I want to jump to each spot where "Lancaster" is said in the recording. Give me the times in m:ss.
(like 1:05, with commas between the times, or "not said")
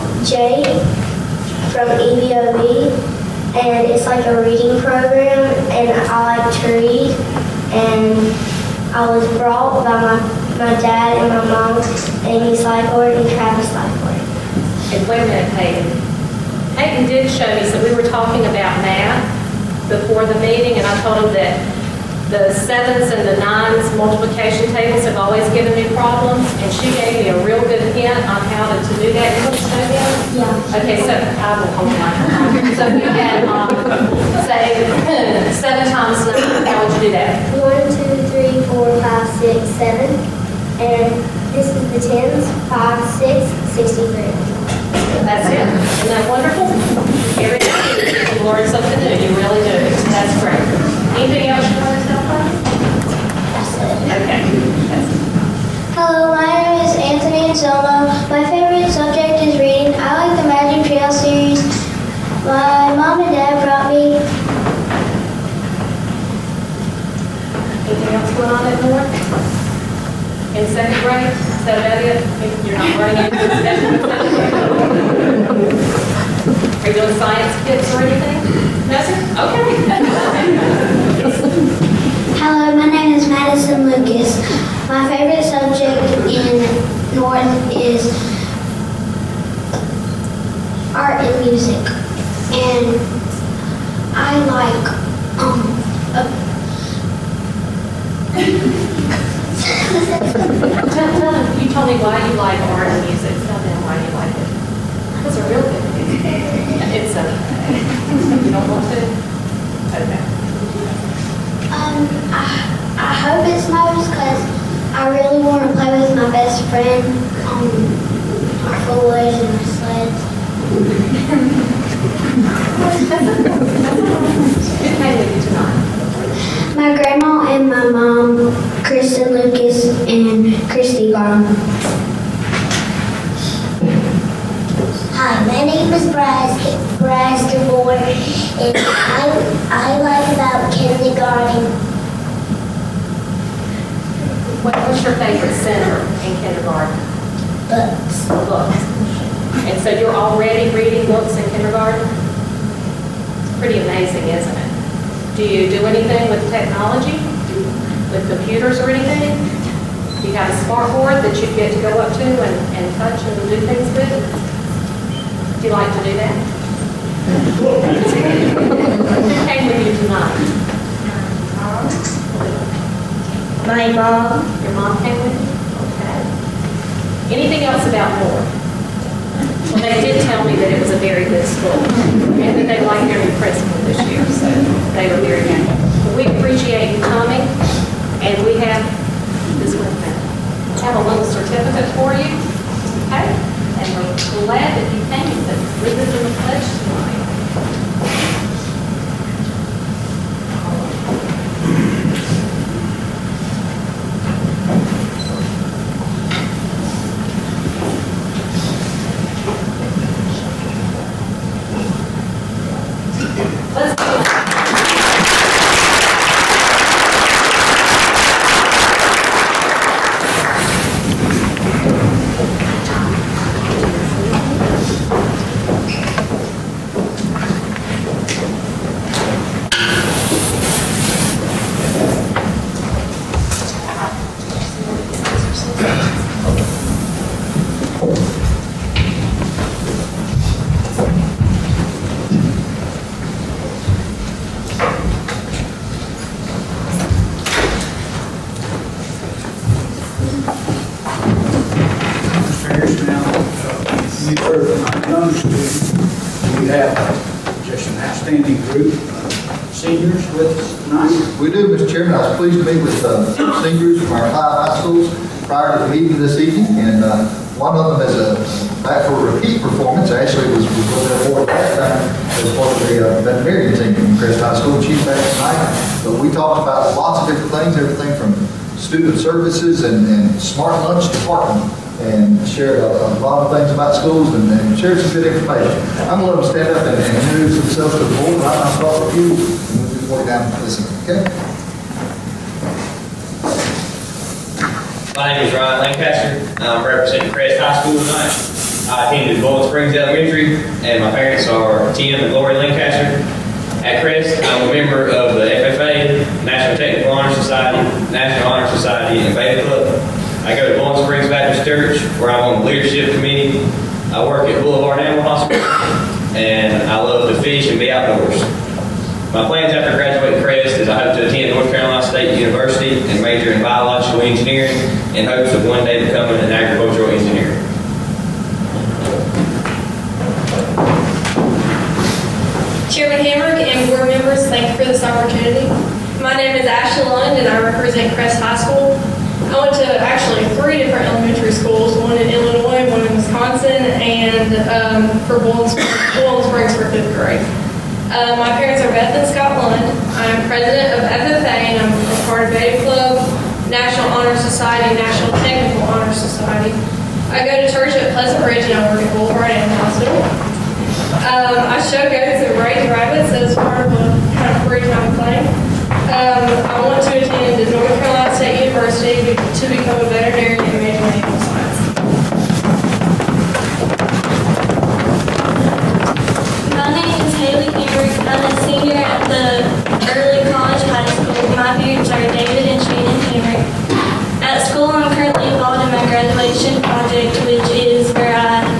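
4:55, 5:02.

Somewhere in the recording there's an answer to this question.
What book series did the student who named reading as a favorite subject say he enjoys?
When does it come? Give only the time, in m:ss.
1:00.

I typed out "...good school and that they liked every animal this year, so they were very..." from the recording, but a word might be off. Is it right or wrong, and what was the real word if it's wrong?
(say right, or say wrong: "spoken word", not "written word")
wrong: "principal", not "animal".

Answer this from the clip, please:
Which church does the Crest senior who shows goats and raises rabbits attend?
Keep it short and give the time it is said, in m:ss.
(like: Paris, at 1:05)
Pleasant Ridge, at 5:58.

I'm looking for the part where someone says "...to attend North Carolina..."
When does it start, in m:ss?
5:21.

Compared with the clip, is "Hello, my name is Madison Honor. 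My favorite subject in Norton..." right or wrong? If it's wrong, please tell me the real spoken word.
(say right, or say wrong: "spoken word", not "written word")
wrong: "Lucas", not "Honor".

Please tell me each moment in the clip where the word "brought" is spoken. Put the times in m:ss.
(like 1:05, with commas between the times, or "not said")
0:09, 1:03.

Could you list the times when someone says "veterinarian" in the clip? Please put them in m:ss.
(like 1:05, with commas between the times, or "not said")
4:33, 6:10.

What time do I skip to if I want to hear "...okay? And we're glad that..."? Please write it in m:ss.
3:13.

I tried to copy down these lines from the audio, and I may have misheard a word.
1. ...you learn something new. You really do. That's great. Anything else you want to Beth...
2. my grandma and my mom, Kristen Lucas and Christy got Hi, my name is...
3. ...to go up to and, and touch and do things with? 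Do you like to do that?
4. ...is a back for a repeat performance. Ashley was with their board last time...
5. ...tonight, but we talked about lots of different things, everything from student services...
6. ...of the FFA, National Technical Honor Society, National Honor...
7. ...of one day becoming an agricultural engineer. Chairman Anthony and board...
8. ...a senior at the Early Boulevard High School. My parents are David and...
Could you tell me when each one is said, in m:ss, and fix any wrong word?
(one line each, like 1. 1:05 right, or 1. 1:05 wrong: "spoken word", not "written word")
1. 0:47 wrong: "Anthony", not "Beth"
2. 2:06 right
3. 2:41 right
4. 4:28 right
5. 4:35 right
6. 5:05 right
7. 5:25 wrong: "Hamrick", not "Anthony"
8. 6:18 wrong: "College", not "Boulevard".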